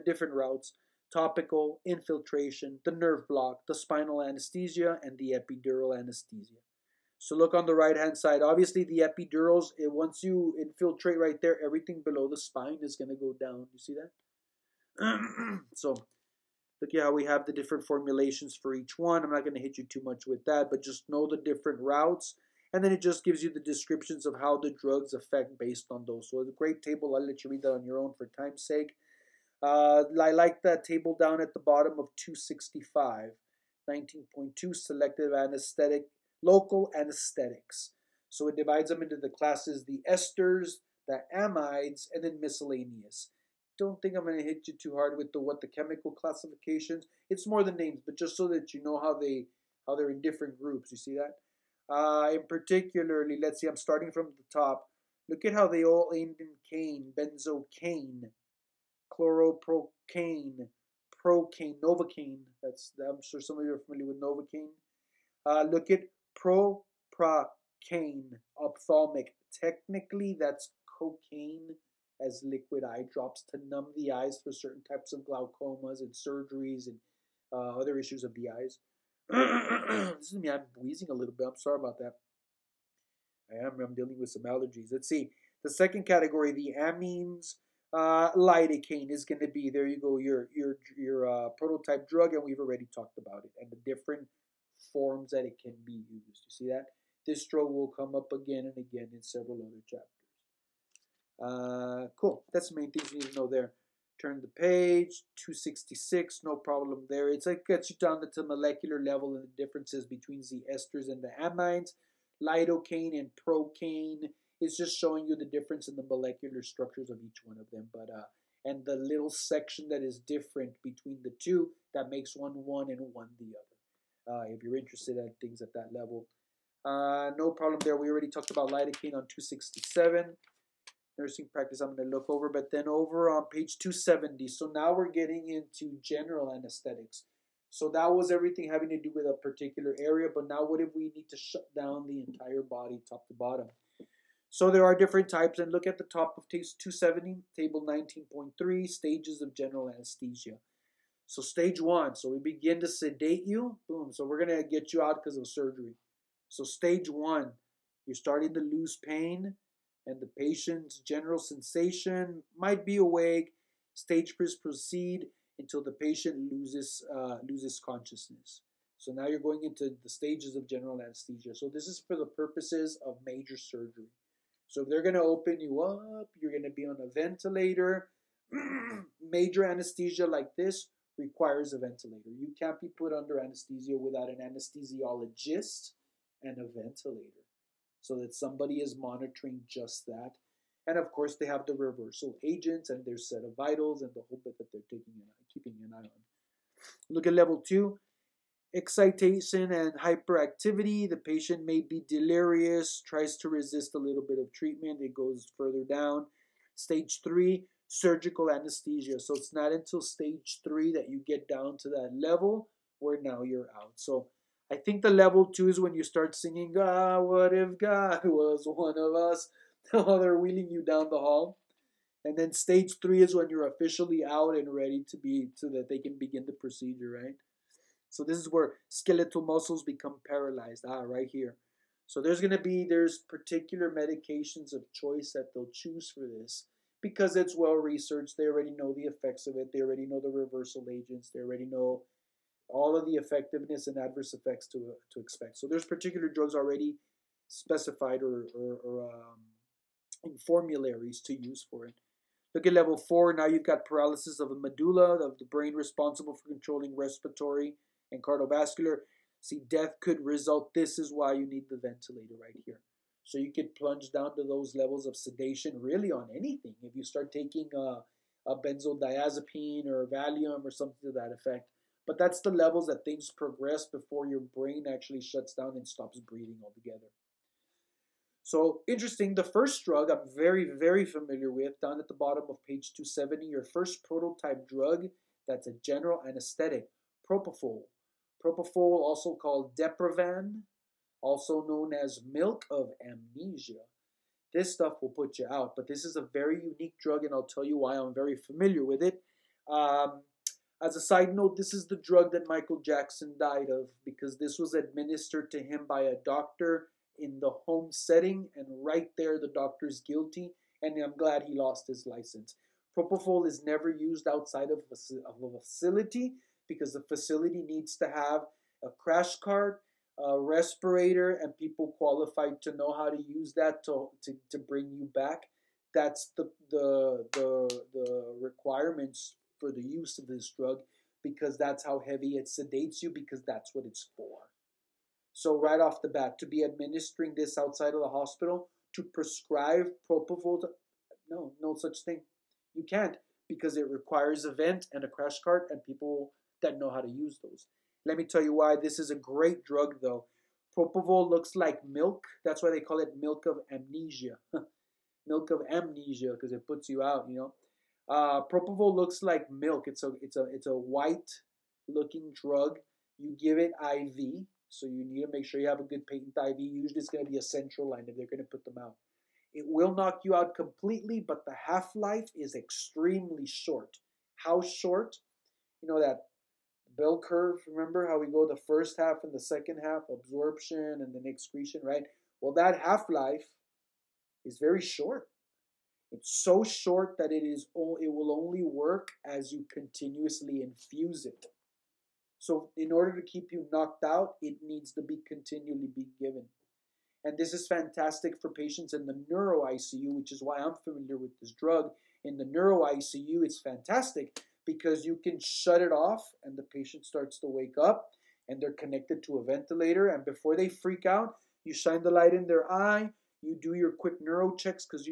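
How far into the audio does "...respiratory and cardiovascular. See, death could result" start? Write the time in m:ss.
4:16.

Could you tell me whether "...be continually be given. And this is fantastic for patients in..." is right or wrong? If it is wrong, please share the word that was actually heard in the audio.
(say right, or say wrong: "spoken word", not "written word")
right.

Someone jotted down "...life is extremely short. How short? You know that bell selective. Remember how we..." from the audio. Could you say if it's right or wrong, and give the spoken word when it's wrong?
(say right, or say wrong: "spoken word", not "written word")
wrong: "curve", not "selective".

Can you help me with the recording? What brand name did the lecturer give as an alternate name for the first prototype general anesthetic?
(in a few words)
Diprivan.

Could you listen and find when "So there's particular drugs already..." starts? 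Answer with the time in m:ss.
4:05.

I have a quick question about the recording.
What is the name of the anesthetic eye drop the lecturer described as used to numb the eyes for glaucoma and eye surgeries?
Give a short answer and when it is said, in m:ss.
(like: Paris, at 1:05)
propracaine, at 1:06.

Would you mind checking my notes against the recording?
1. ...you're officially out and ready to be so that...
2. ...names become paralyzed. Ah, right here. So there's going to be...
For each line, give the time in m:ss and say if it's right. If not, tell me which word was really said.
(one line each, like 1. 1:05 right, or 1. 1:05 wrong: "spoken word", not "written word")
1. 3:43 right
2. 3:49 wrong: "muscles", not "names".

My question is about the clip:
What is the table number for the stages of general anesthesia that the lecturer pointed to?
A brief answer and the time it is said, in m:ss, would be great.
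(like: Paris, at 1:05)
19.3, at 2:27.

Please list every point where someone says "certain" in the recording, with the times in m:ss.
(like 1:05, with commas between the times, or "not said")
1:14.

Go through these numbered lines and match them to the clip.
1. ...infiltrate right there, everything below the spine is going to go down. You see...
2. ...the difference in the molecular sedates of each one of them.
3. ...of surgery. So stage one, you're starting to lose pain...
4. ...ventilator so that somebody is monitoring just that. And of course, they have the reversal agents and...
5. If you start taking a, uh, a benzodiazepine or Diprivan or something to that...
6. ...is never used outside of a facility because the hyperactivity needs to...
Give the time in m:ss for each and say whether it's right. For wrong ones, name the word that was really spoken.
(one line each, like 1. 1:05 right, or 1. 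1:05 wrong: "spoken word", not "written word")
1. 0:10 right
2. 1:55 wrong: "structures", not "sedates"
3. 2:35 right
4. 3:06 right
5. 4:26 wrong: "Valium", not "Diprivan"
6. 5:13 wrong: "facility", not "hyperactivity".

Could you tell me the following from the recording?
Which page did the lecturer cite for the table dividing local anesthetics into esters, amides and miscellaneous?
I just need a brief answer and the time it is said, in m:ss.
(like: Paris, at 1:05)
265, at 0:32.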